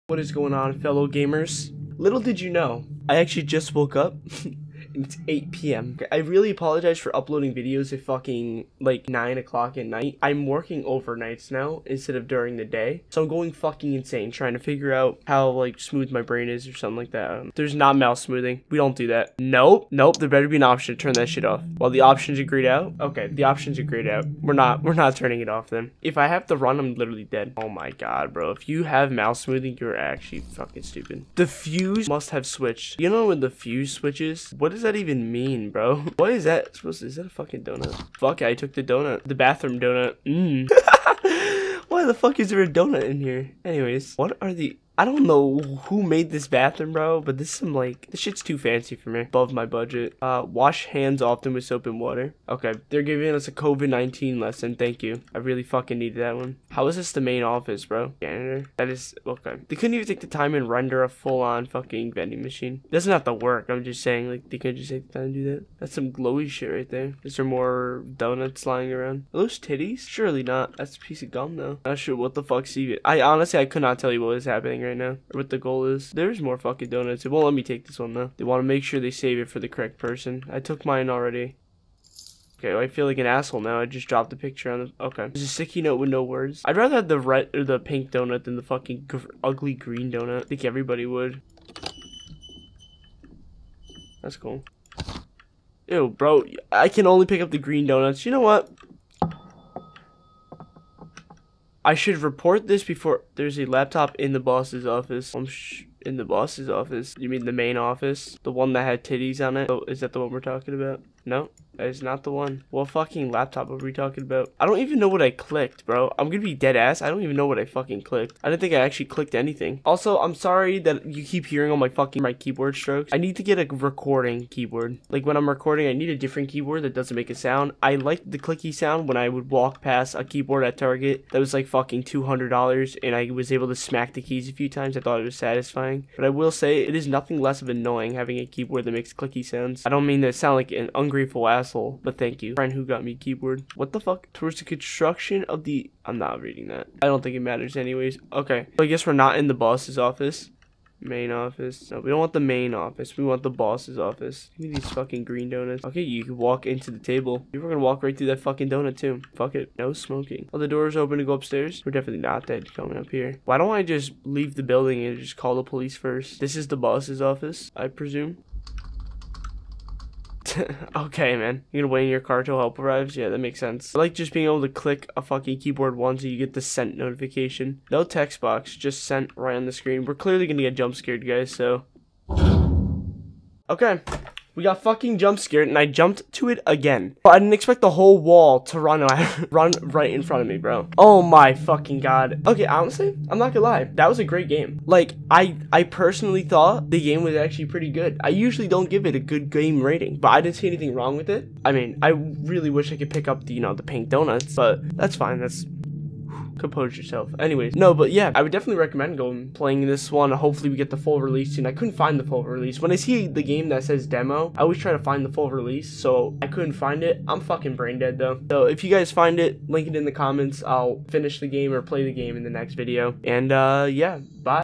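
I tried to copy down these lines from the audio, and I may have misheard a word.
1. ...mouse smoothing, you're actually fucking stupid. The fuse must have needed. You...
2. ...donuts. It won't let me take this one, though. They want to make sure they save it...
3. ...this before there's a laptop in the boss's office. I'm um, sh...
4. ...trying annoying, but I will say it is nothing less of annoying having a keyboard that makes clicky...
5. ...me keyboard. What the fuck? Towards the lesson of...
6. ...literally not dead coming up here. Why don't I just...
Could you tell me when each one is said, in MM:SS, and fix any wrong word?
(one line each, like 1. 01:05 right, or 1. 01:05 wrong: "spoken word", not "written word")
1. 00:29 wrong: "switched", not "needed"
2. 01:16 right
3. 01:42 right
4. 02:15 wrong: "satisfying", not "trying"
5. 02:23 wrong: "construction", not "lesson"
6. 02:41 wrong: "definitely", not "literally".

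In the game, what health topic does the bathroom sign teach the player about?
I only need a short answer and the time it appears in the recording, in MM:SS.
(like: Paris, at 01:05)
COVID-19, at 00:53.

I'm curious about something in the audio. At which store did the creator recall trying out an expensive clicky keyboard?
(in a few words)
Target.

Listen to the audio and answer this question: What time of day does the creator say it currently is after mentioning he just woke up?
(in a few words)
8 p.m.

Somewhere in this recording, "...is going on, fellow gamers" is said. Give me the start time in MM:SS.
00:00.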